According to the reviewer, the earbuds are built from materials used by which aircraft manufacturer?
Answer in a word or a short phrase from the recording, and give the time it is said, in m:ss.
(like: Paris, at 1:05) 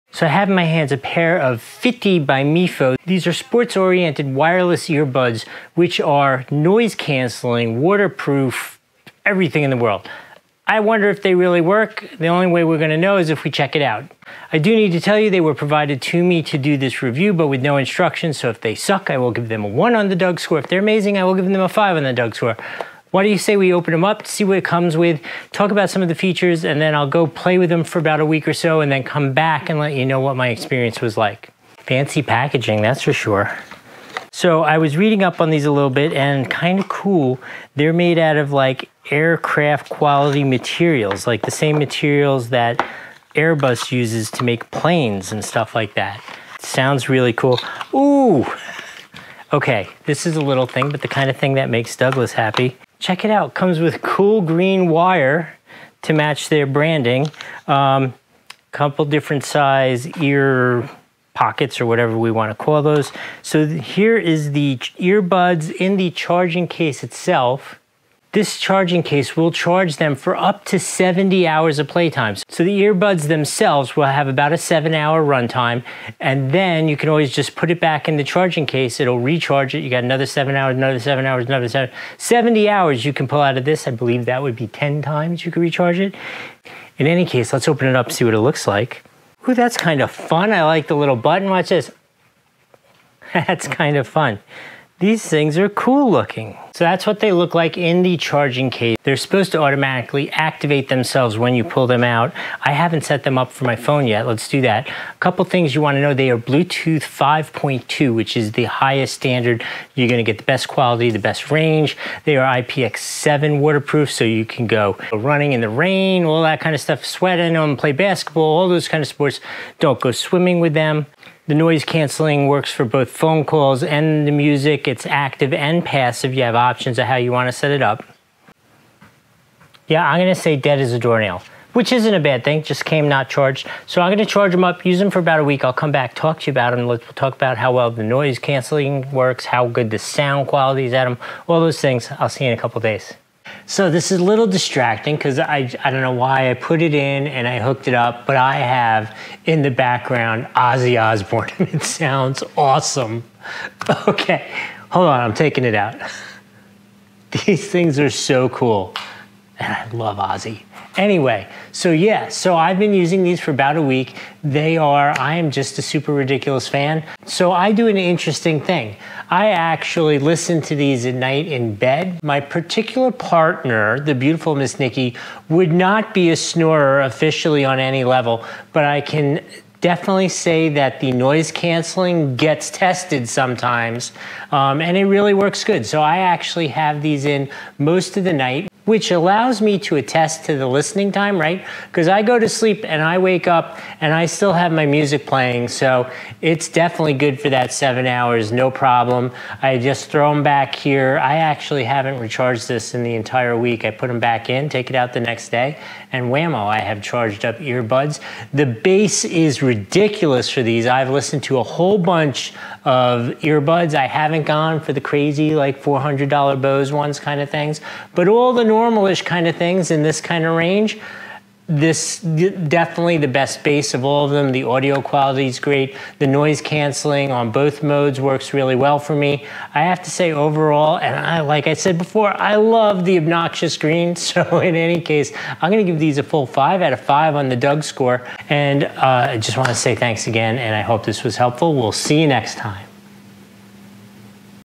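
Airbus, at 0:43.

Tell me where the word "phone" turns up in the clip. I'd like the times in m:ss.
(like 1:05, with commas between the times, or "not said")
1:43, 2:03.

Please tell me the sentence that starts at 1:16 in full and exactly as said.
And then you can always just put it back in the charging case.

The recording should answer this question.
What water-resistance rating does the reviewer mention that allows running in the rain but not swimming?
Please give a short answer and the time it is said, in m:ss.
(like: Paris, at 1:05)
IPX7, at 1:52.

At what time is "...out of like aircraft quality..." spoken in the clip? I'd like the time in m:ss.
0:38.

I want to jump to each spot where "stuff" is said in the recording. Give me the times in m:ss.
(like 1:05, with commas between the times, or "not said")
0:45, 1:56.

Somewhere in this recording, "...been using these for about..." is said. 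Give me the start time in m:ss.
2:42.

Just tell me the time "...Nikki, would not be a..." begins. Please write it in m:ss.
2:54.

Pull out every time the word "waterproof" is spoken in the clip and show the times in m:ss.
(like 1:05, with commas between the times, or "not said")
0:07, 1:53.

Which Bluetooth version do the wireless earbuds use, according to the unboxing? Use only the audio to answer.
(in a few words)
5.2.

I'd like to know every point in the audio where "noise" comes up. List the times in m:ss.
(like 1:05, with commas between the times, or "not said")
0:06, 2:01, 2:18, 3:01, 3:46.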